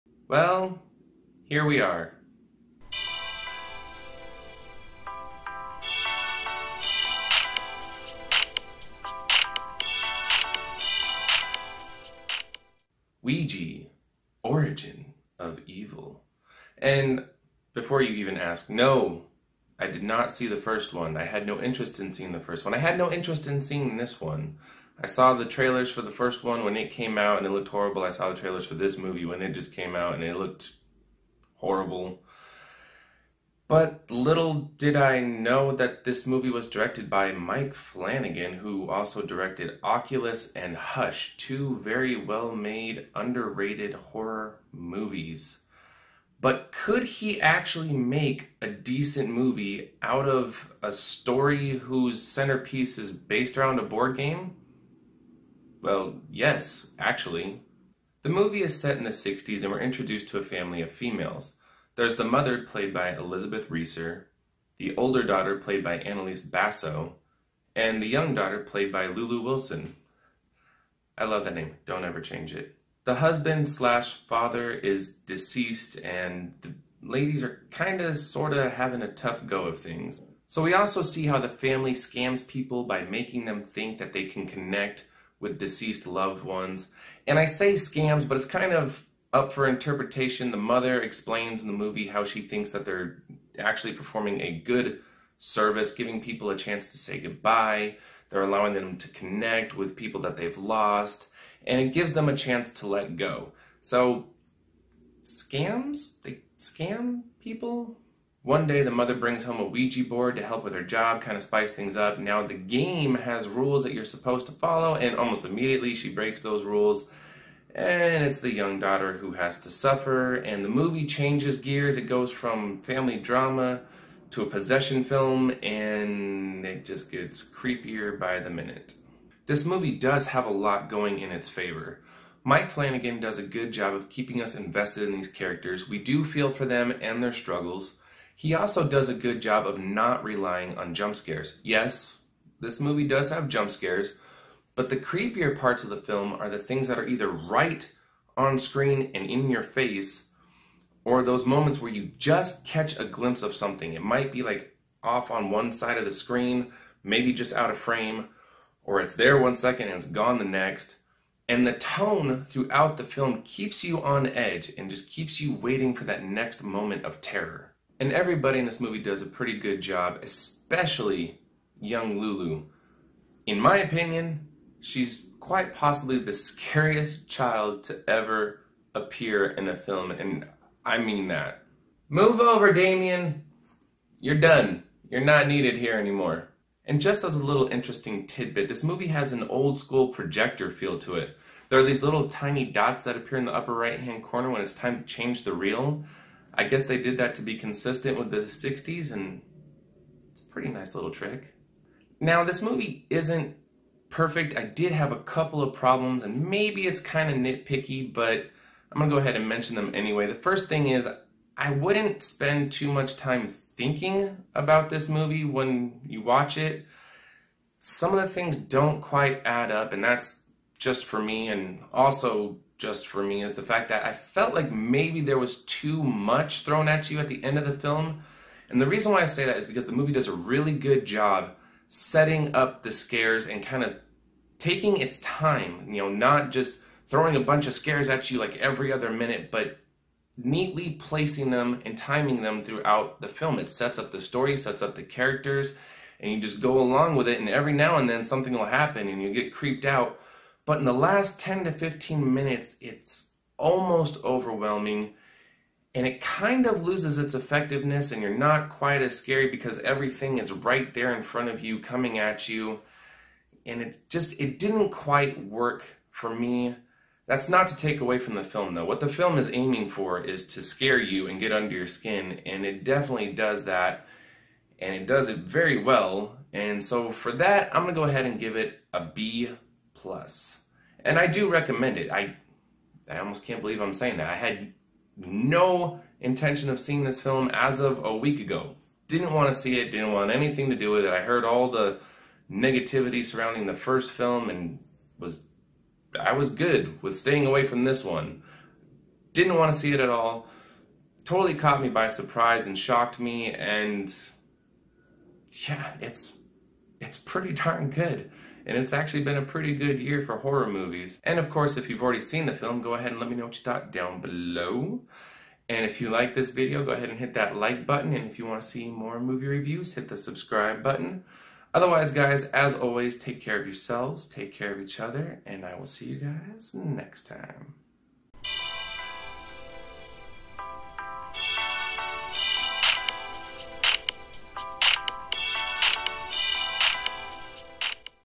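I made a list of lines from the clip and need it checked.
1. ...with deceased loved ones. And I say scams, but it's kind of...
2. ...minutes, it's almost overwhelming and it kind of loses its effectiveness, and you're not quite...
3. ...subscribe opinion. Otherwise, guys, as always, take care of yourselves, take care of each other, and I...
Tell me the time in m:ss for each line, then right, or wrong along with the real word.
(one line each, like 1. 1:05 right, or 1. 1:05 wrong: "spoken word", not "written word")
1. 1:25 right
2. 4:12 right
3. 5:20 wrong: "button", not "opinion".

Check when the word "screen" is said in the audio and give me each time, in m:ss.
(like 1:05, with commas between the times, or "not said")
2:28, 2:36.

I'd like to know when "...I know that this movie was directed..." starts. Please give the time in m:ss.
0:34.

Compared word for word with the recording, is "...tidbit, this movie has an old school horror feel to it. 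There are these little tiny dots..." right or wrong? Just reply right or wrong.
wrong.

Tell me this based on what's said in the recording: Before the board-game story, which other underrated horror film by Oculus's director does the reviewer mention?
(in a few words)
Hush.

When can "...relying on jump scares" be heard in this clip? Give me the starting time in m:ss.
2:20.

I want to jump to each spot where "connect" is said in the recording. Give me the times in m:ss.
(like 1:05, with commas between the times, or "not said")
1:24, 1:39.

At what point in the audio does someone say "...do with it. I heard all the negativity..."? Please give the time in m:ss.
4:50.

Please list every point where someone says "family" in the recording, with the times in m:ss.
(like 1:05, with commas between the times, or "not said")
1:00, 1:21, 2:02.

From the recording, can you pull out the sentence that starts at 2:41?
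And the tone throughout the film keeps you on edge and just keeps you waiting for that next moment of terror.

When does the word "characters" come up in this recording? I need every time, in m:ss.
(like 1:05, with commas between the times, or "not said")
2:15, 4:05.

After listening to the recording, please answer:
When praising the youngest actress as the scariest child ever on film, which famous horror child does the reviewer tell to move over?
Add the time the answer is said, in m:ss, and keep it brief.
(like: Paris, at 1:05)
Damien, at 3:02.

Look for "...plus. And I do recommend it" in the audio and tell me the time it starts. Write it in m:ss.
4:39.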